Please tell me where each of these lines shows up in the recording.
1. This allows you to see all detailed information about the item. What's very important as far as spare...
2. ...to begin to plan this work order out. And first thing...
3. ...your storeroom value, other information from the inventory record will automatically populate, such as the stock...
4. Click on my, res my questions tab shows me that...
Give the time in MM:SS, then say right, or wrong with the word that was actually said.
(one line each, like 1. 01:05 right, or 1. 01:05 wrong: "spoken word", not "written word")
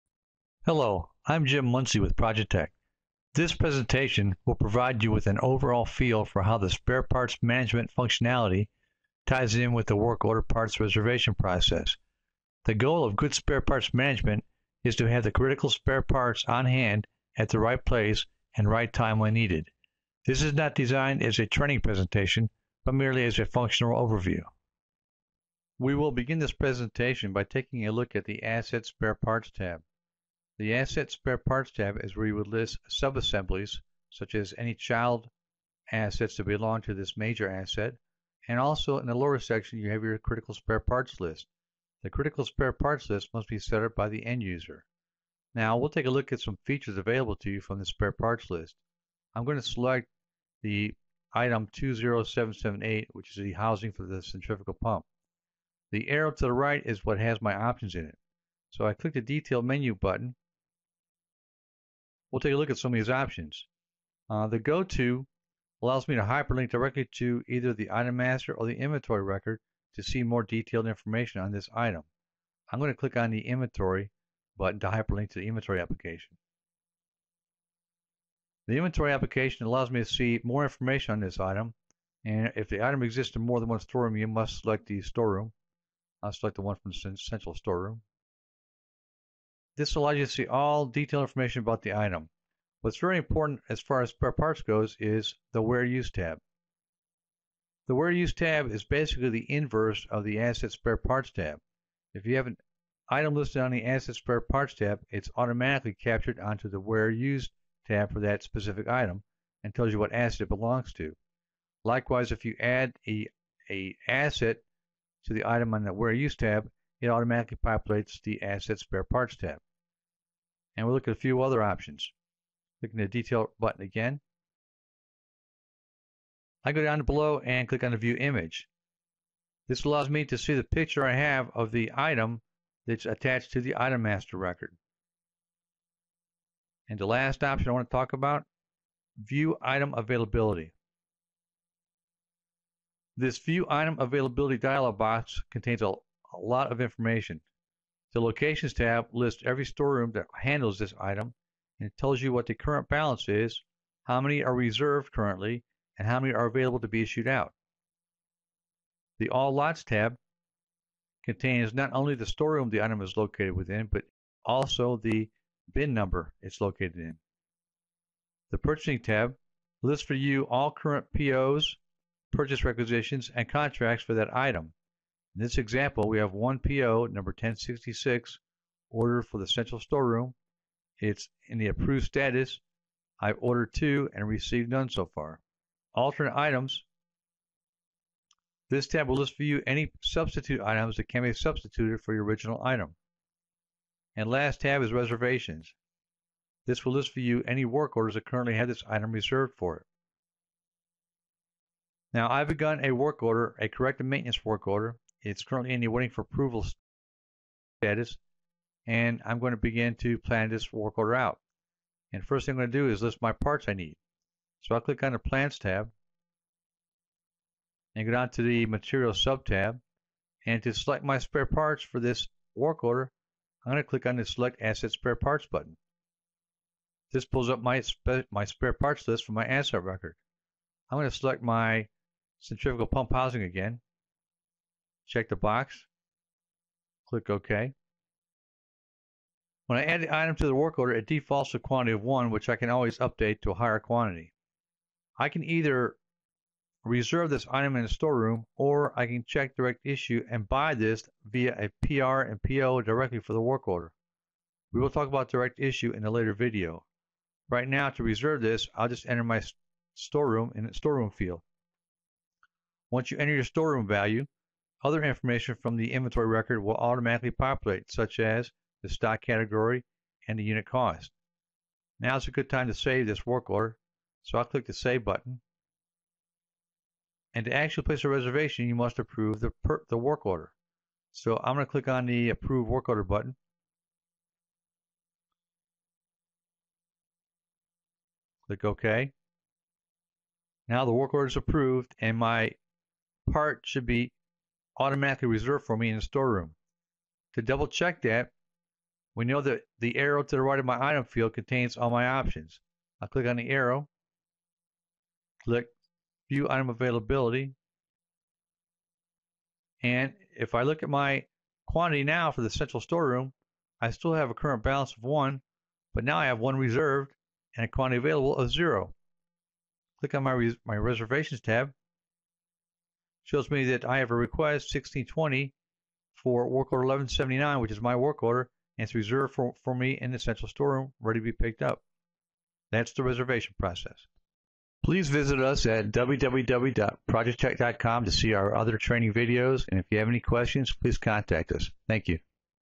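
1. 01:29 right
2. 03:29 right
3. 04:23 right
4. 05:19 wrong: "reservations", not "questions".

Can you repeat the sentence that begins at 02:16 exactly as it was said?
And the last option I want to talk about, View Item Availability.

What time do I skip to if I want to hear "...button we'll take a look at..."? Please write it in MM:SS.
00:59.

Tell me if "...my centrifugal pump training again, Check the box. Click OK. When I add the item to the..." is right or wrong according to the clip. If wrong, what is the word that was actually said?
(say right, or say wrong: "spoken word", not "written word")
wrong: "housing", not "training".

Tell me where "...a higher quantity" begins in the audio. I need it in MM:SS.
04:03.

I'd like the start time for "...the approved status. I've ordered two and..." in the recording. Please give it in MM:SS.
03:01.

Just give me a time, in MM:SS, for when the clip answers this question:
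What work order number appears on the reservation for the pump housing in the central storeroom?
05:26.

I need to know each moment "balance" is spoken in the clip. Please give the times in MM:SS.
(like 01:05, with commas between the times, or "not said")
02:32, 05:14.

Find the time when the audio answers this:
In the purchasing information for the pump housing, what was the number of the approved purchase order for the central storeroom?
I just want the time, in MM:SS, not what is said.
02:57.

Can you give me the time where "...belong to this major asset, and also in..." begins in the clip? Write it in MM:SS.
00:36.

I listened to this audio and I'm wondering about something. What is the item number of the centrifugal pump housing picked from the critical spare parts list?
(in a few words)
20778.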